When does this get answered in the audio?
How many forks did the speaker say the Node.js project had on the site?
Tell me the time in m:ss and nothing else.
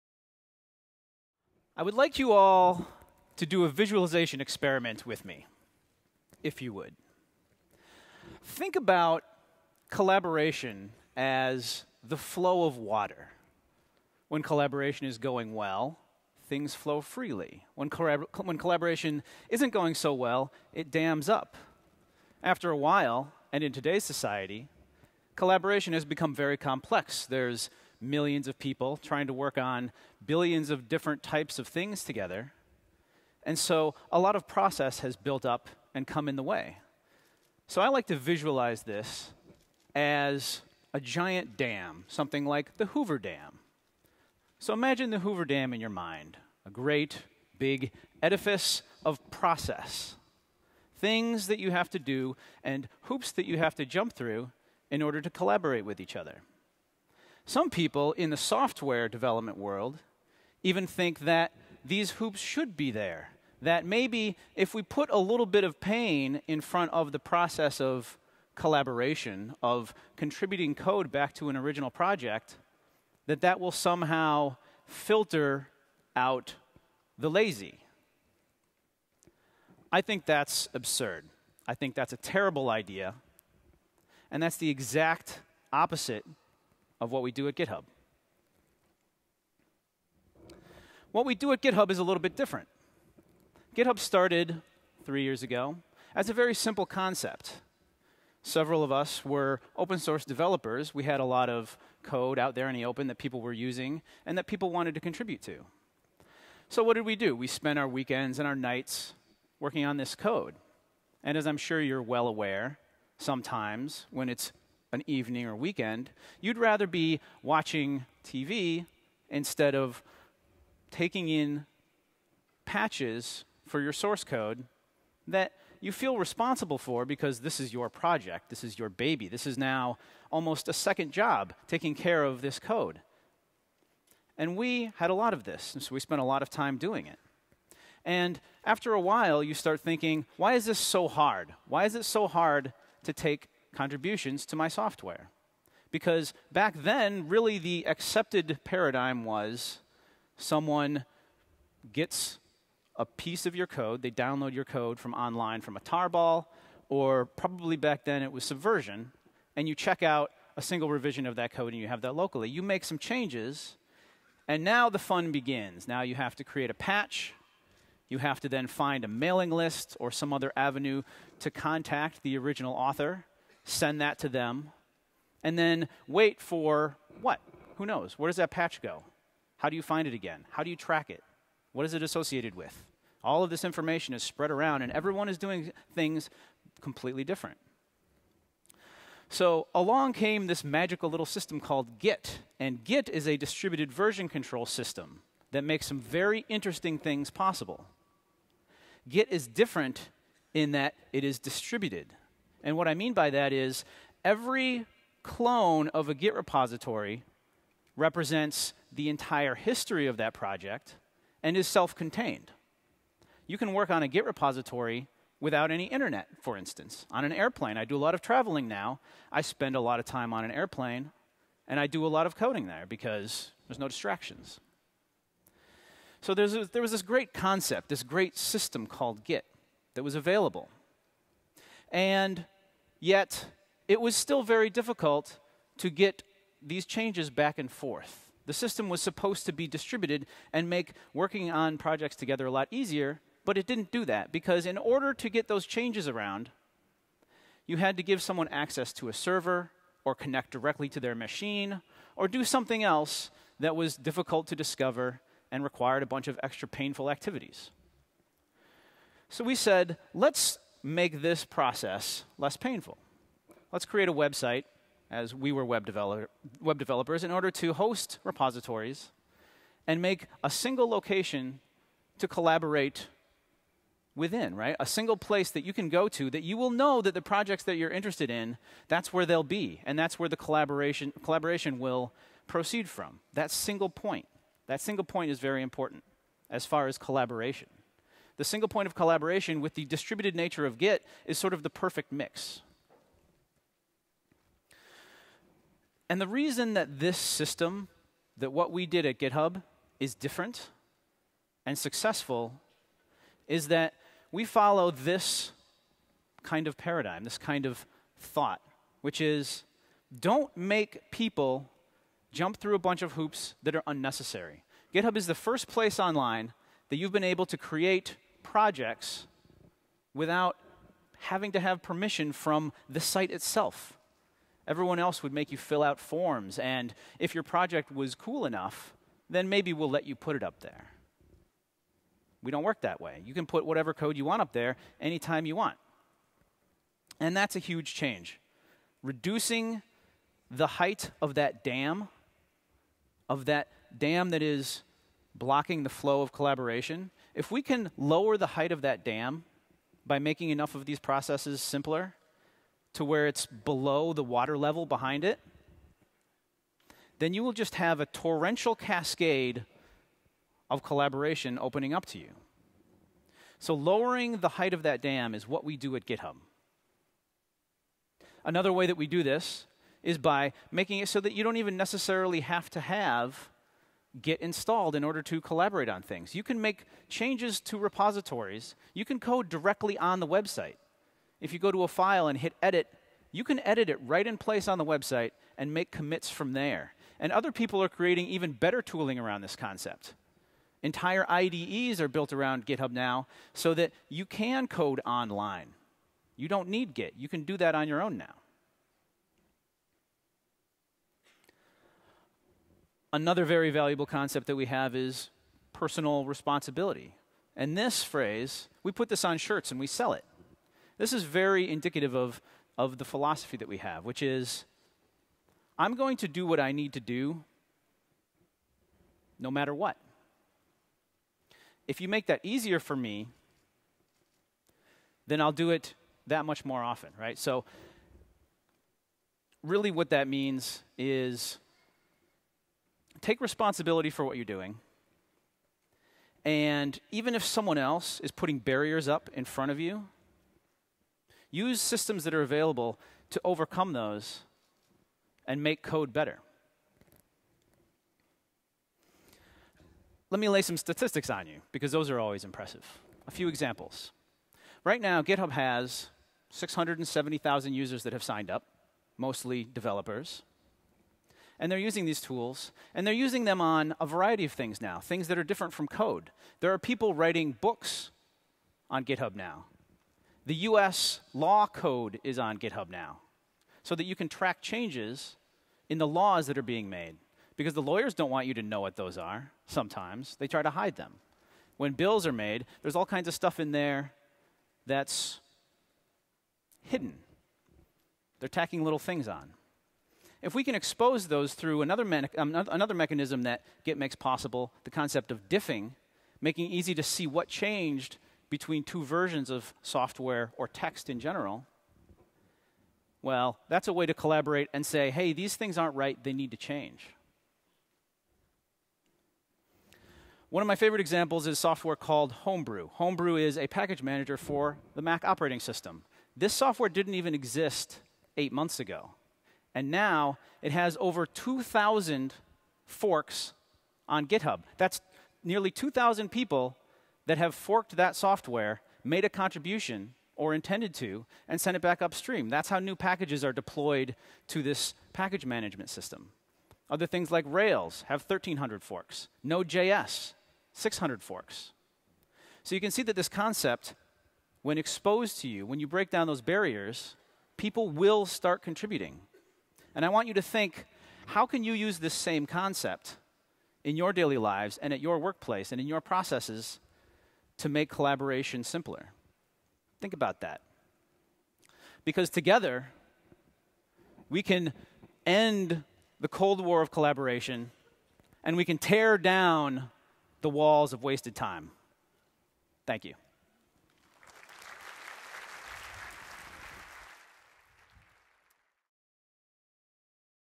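9:00.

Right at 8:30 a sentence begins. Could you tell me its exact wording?
One of my favorite examples is software called Homebrew.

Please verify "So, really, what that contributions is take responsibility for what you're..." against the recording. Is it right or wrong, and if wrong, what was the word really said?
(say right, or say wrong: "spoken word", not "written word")
wrong: "means", not "contributions".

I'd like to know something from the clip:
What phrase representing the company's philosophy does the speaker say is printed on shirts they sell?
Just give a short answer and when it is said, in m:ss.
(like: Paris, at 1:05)
personal responsibility, at 6:45.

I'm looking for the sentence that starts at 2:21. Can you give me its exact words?
Why is it so hard to take contributions to my software.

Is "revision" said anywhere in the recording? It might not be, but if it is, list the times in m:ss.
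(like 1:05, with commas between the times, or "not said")
2:40.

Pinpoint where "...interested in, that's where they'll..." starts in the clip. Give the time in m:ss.
4:37.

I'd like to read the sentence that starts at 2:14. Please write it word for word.
And we had a lot of this, and so we spent a lot of time doing it.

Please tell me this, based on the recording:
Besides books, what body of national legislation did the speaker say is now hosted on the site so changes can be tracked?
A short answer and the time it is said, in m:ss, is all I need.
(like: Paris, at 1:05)
US law code, at 7:50.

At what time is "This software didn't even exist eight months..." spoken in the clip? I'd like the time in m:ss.
8:36.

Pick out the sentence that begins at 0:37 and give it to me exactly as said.
So I like to visualize this as a giant dam, something like the Hoover Dam.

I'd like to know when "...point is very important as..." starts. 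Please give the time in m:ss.
4:45.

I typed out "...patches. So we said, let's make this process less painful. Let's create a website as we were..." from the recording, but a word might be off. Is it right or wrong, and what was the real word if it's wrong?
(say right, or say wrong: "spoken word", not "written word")
wrong: "activities", not "patches".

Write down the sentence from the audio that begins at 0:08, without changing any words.
Think about collaboration as the flow of water.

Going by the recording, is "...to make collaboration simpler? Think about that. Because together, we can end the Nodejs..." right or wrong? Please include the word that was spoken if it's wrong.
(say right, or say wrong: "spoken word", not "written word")
wrong: "Cold", not "Nodejs".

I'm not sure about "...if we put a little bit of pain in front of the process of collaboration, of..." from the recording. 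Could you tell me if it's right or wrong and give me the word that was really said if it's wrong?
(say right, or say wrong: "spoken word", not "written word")
right.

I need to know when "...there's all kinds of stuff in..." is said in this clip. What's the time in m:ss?
8:02.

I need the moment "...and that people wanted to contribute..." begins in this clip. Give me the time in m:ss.
1:44.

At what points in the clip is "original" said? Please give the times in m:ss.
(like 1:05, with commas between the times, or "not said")
1:11, 2:52.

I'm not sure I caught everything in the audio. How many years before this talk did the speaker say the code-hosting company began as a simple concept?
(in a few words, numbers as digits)
3.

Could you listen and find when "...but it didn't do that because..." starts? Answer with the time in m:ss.
4:03.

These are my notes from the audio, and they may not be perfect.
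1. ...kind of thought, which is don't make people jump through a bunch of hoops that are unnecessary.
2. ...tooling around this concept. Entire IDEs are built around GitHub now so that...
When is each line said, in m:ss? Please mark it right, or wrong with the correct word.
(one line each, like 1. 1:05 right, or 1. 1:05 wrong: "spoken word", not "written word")
1. 5:07 right
2. 6:28 right.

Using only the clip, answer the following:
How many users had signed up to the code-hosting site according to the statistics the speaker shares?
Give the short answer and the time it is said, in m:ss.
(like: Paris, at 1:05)
670,000, at 7:36.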